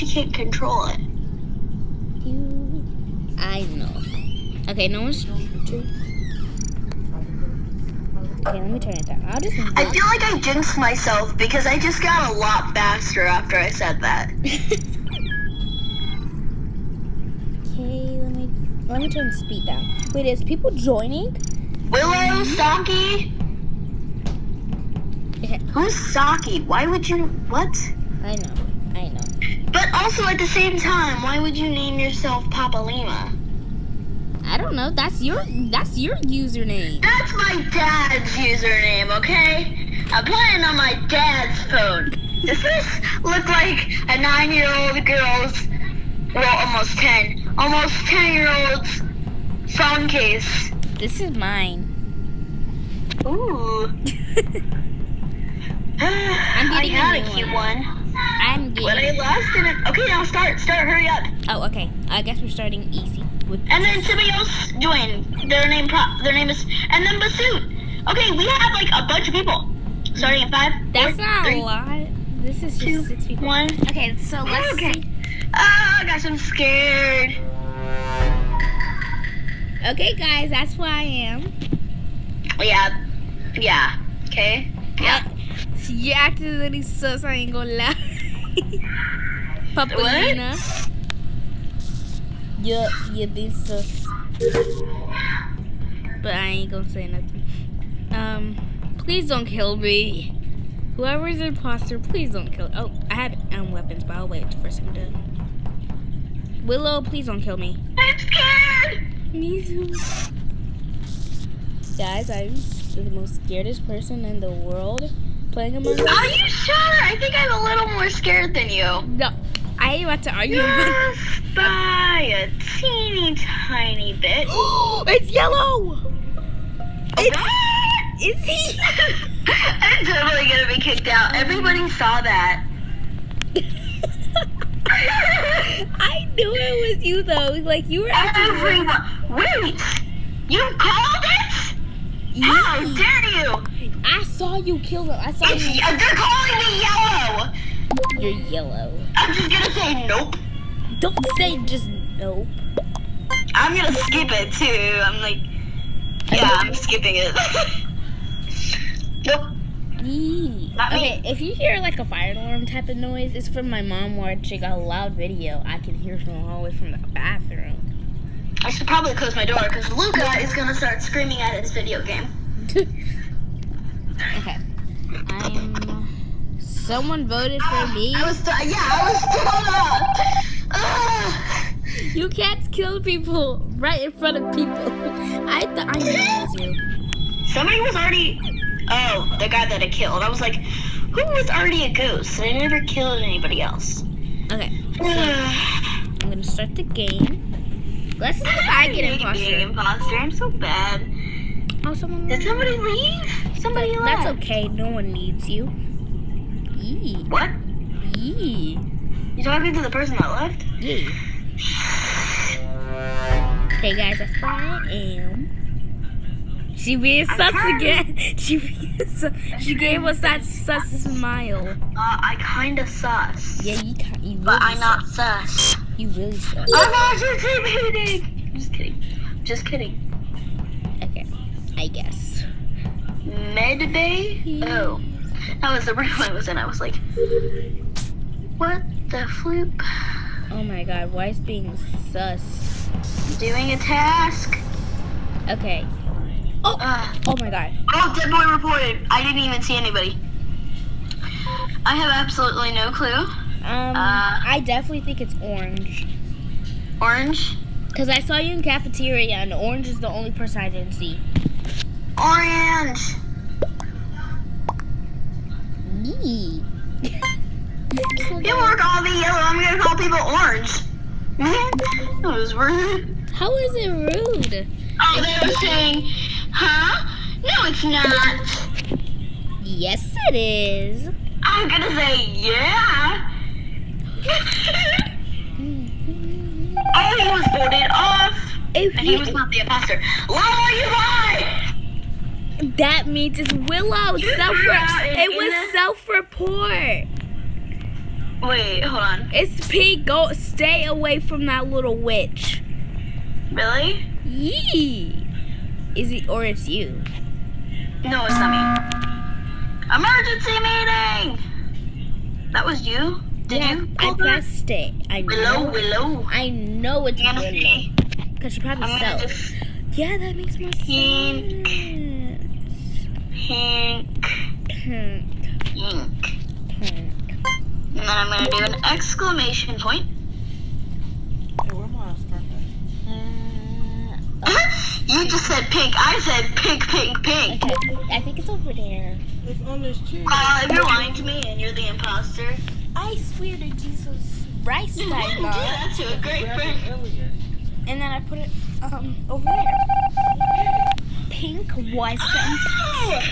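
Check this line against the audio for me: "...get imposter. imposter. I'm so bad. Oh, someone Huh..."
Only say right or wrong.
wrong.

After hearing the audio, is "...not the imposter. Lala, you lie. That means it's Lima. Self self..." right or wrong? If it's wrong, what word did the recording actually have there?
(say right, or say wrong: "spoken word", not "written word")
wrong: "Willow", not "Lima".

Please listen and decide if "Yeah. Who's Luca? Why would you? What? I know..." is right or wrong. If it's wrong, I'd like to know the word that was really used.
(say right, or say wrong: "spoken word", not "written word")
wrong: "Saki", not "Luca".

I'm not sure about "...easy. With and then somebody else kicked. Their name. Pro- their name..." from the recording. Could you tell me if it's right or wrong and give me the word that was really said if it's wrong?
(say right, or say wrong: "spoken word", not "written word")
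wrong: "joined", not "kicked".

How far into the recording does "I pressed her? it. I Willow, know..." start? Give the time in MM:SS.
05:13.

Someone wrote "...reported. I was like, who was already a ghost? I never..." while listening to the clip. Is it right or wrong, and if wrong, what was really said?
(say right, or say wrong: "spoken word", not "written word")
wrong: "killed", not "reported".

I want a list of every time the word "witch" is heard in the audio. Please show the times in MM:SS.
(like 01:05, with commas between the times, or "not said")
05:01.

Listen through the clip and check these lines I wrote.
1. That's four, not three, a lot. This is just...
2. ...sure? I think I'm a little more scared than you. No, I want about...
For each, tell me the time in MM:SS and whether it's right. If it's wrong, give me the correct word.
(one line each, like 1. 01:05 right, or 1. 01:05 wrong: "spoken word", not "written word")
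1. 01:10 right
2. 01:56 right.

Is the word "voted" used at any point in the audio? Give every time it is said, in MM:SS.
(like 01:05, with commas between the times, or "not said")
02:57, 04:47.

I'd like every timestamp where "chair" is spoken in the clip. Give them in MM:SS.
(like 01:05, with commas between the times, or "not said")
05:40.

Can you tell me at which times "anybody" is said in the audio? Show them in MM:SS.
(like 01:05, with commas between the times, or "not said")
03:13, 04:09.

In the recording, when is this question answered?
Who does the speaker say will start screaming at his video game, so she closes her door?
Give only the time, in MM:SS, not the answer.
02:49.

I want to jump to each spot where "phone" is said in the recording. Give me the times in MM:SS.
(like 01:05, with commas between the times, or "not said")
00:41, 00:49.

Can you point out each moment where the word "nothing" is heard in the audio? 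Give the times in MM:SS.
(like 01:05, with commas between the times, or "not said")
01:37.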